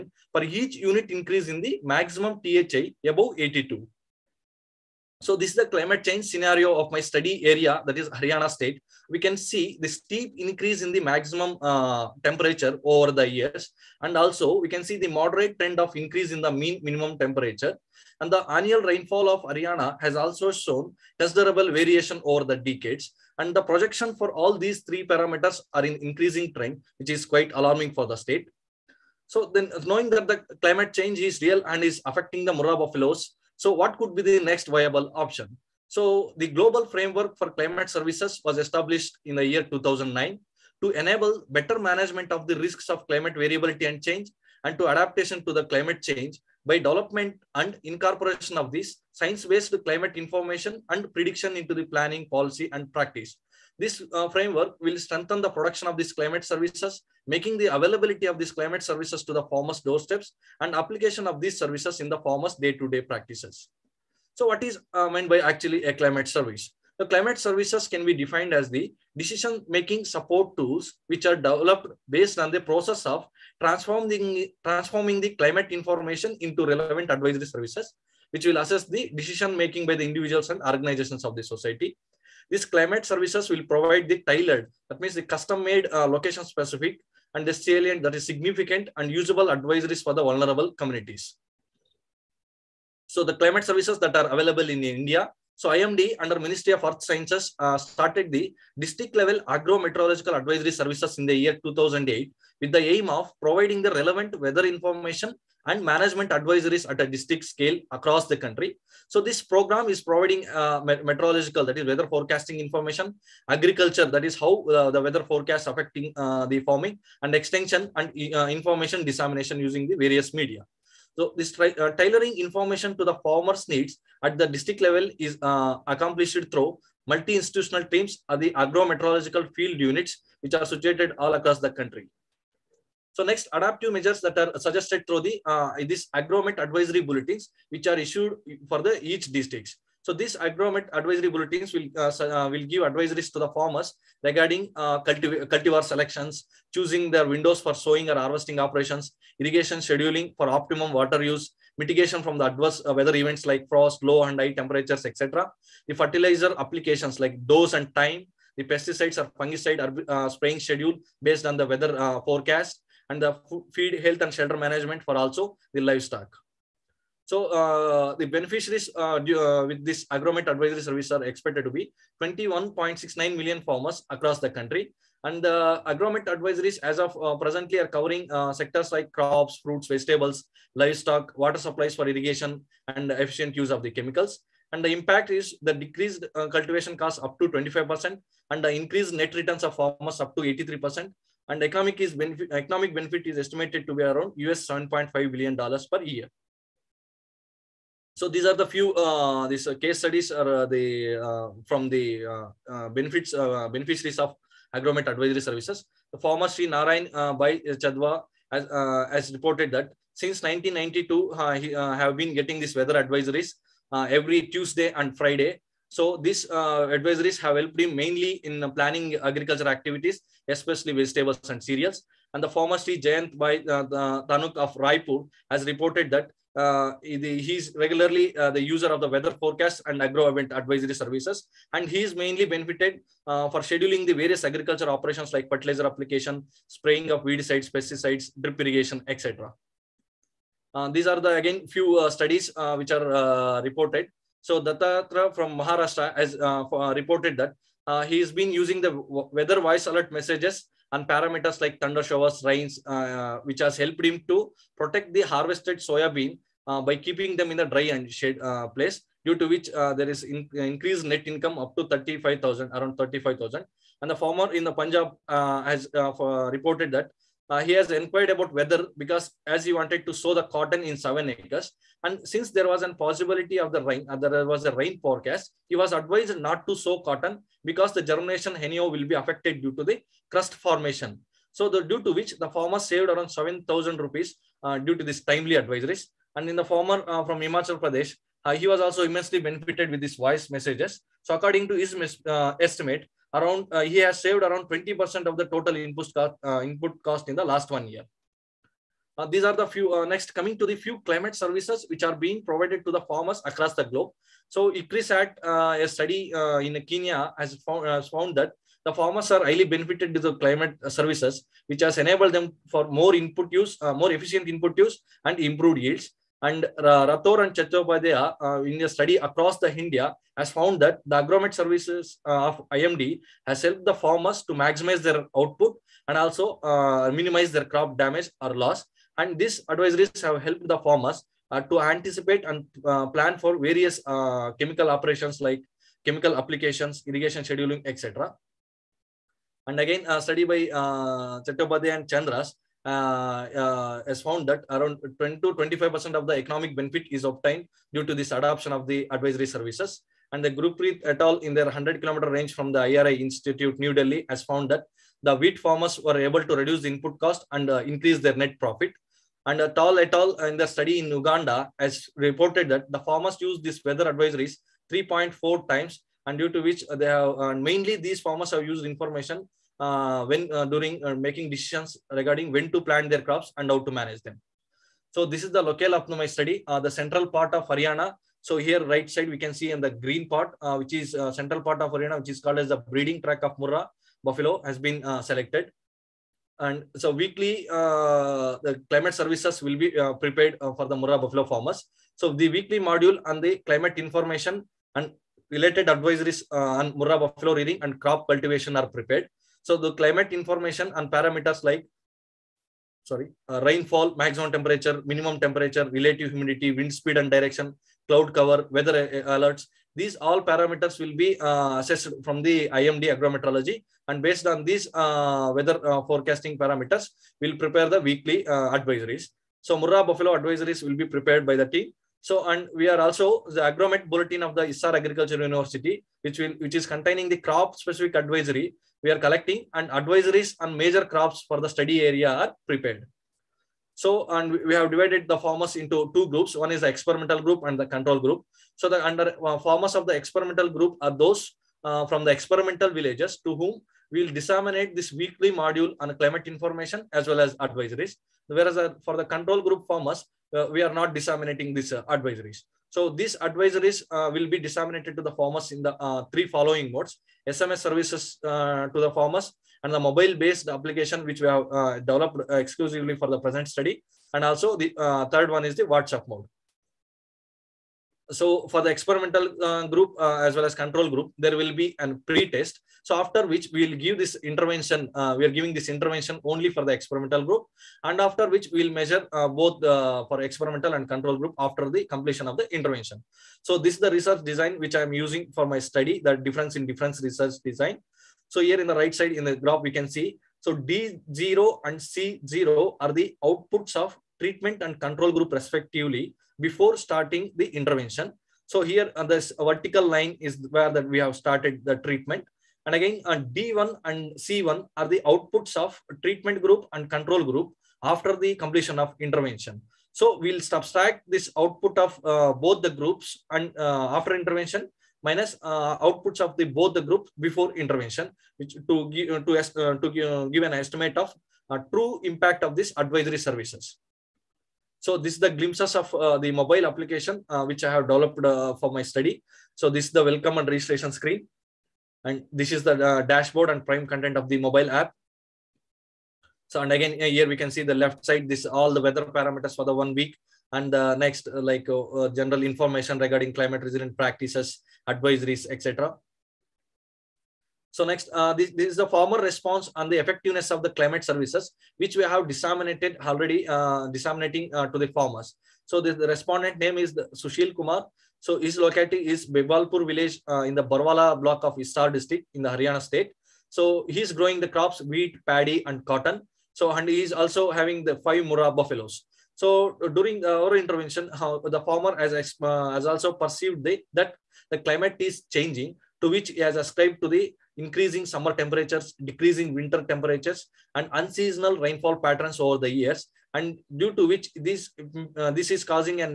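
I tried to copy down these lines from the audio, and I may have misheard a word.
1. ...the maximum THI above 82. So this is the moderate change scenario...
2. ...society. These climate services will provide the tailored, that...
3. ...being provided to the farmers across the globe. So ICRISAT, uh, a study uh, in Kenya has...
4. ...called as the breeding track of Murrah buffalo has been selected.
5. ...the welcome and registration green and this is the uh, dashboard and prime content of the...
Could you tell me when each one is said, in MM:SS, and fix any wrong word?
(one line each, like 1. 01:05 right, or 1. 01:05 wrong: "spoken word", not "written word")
1. 00:01 wrong: "climate", not "moderate"
2. 01:21 right
3. 05:02 right
4. 06:22 right
5. 08:50 wrong: "screen", not "green".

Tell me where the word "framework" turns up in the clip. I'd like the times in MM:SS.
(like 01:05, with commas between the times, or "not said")
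00:36, 00:54.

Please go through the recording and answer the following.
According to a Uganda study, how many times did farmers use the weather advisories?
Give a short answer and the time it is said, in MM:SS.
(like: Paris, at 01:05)
3.4 times, at 06:04.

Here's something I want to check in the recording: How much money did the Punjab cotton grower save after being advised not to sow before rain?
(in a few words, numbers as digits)
7000 rupees.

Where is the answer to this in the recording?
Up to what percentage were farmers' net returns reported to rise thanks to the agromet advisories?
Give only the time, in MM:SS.
03:10.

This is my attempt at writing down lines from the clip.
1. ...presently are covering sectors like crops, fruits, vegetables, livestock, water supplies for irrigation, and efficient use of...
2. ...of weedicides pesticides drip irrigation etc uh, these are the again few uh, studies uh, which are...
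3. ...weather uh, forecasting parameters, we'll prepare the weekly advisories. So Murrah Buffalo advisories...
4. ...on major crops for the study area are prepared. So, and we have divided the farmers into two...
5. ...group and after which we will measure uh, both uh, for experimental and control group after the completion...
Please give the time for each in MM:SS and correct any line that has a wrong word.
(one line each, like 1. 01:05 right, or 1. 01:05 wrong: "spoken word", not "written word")
1. 02:57 right
2. 03:57 right
3. 06:55 right
4. 07:10 right
5. 07:57 right.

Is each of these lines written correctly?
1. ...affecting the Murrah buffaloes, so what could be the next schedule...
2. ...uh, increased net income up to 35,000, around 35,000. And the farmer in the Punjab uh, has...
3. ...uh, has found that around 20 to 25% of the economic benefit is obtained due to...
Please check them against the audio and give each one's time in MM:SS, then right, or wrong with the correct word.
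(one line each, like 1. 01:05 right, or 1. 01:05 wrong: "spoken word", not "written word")
1. 00:32 wrong: "viable", not "schedule"
2. 04:20 right
3. 05:43 right.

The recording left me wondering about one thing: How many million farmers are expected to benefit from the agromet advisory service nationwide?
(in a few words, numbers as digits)
21.69 million.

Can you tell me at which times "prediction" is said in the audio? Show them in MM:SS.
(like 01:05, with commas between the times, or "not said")
00:51.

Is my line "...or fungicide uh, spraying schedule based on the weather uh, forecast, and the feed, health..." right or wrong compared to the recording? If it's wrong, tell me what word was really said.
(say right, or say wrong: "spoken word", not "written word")
right.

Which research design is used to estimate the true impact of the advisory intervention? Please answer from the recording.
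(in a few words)
Difference in difference.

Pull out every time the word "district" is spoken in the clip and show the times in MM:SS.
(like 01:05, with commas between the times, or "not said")
01:38, 01:47, 02:04, 02:19, 09:22.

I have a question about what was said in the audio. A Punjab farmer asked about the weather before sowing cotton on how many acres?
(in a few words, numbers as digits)
7.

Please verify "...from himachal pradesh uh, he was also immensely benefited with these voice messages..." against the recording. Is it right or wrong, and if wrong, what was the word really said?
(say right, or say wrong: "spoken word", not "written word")
right.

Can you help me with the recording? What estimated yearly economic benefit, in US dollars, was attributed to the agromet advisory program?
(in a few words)
7.5 billion dollars.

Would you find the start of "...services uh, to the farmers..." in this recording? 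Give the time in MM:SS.
07:37.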